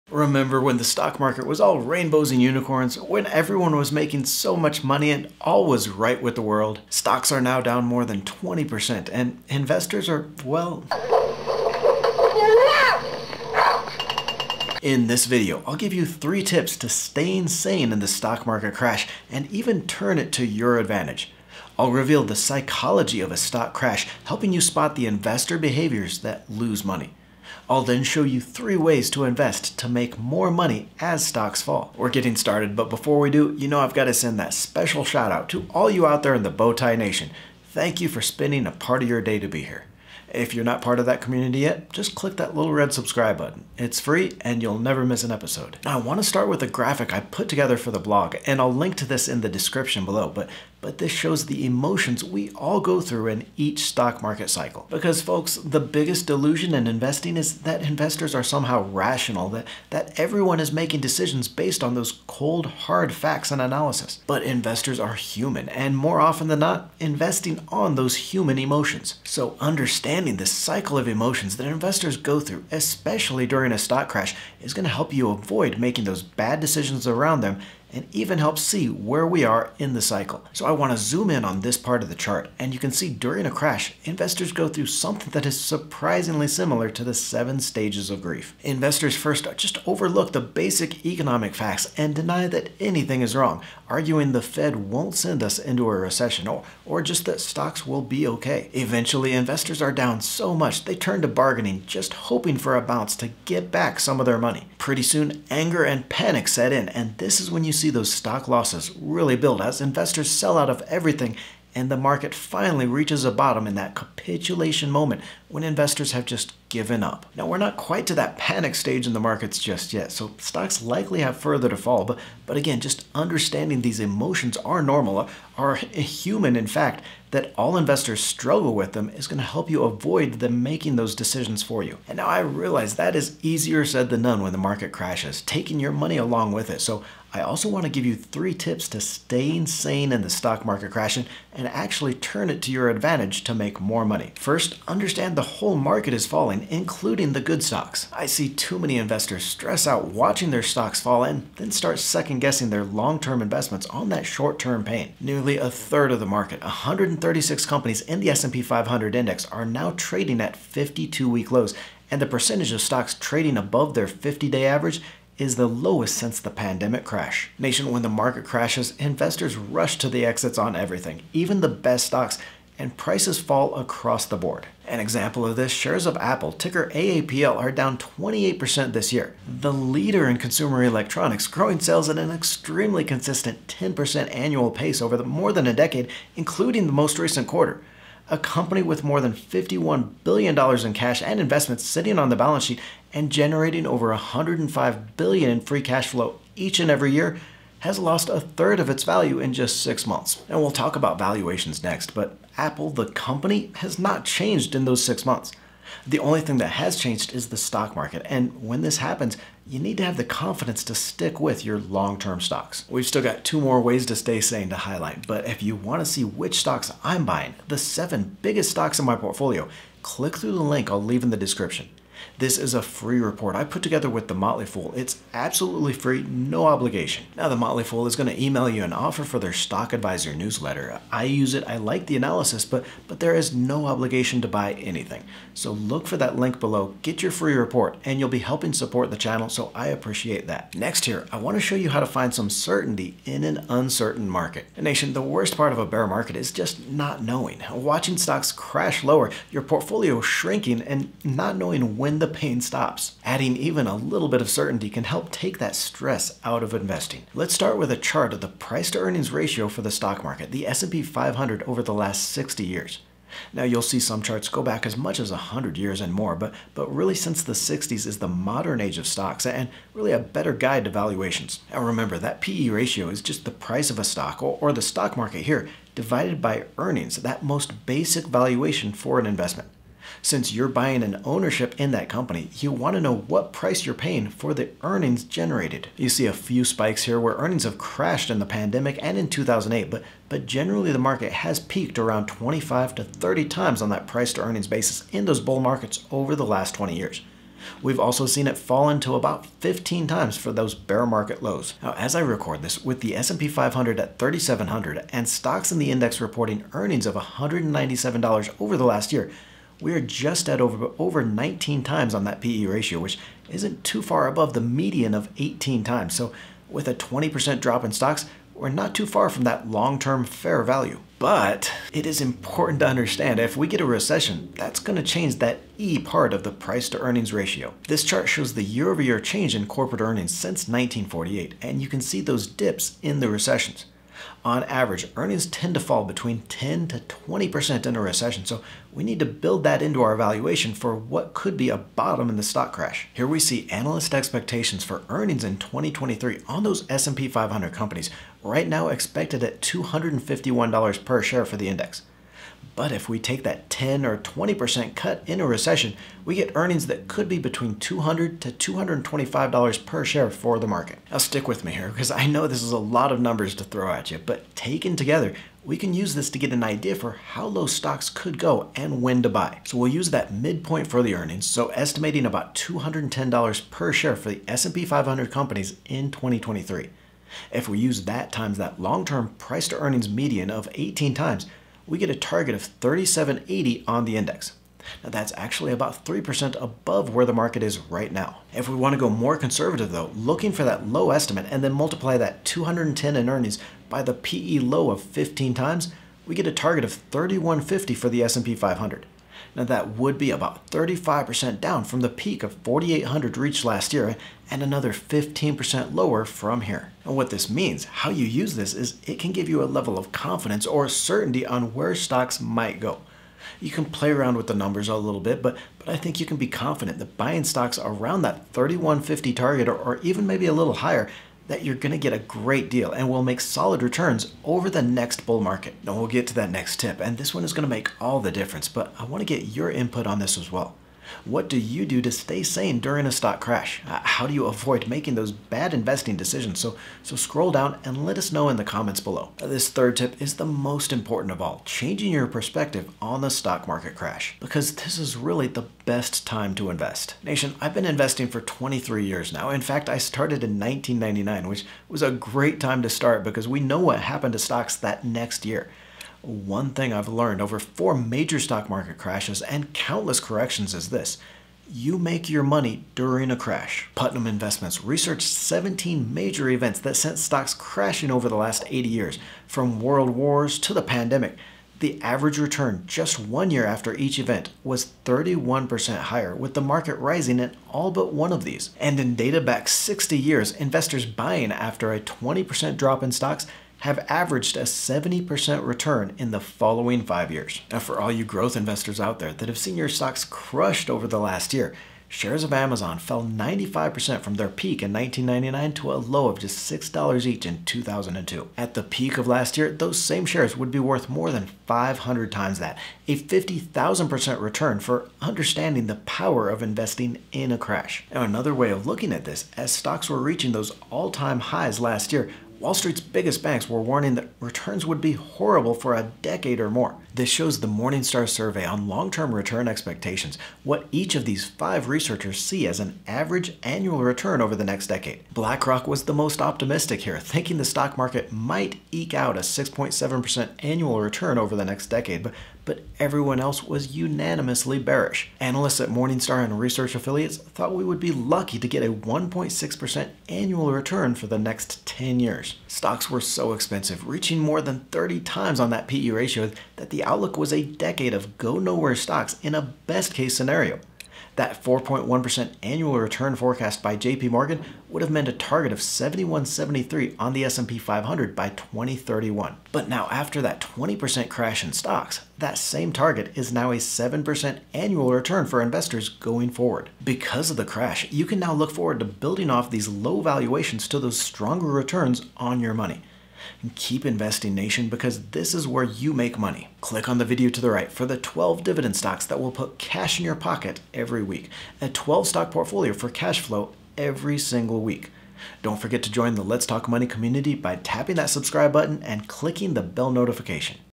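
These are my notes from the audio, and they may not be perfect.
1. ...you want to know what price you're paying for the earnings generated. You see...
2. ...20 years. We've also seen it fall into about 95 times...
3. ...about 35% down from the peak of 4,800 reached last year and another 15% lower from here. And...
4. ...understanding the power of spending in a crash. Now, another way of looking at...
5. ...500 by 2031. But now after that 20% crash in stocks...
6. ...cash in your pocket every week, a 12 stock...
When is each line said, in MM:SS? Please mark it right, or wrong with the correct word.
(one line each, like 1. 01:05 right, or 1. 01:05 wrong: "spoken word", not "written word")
1. 04:42 right
2. 04:56 wrong: "15", not "95"
3. 06:40 right
4. 08:25 wrong: "investing", not "spending"
5. 09:17 right
6. 09:39 right.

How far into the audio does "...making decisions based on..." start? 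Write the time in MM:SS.
01:00.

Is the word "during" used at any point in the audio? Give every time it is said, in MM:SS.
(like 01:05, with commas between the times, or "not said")
01:13, 01:23, 07:12, 07:42.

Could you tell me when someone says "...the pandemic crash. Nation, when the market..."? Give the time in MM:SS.
02:46.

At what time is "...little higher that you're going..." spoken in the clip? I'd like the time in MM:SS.
07:00.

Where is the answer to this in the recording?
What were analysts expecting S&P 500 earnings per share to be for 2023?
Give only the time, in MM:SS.
05:49.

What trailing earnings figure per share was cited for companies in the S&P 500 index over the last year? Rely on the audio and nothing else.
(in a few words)
$197.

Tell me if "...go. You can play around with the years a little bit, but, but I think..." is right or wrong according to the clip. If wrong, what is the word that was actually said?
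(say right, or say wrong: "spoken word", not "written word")
wrong: "numbers", not "years".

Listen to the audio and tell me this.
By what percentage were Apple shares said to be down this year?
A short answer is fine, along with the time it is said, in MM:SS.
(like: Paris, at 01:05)
28%, at 02:57.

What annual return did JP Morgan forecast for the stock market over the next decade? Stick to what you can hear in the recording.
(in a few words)
4.1%.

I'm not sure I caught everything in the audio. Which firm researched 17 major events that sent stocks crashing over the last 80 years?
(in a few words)
Putnam Investments.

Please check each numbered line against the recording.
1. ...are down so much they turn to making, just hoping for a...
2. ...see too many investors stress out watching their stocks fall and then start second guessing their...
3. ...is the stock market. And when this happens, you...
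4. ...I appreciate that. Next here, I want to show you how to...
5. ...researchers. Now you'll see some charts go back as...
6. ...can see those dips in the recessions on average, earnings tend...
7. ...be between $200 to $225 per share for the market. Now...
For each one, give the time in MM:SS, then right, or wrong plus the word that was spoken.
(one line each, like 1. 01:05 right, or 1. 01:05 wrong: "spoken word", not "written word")
1. 01:39 wrong: "bargaining", not "making"
2. 02:28 right
3. 03:27 right
4. 03:59 right
5. 04:22 wrong: "years", not "researchers"
6. 05:31 right
7. 05:57 right.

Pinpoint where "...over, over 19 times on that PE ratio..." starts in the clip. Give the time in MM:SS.
05:10.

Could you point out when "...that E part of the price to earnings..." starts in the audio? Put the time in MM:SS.
05:25.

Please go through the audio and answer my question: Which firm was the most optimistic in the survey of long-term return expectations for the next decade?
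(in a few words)
BlackRock.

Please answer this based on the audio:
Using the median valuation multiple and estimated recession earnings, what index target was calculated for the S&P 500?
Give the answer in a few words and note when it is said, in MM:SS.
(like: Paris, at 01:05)
3780, at 06:22.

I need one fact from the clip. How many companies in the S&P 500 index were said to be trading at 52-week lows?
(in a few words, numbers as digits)
136.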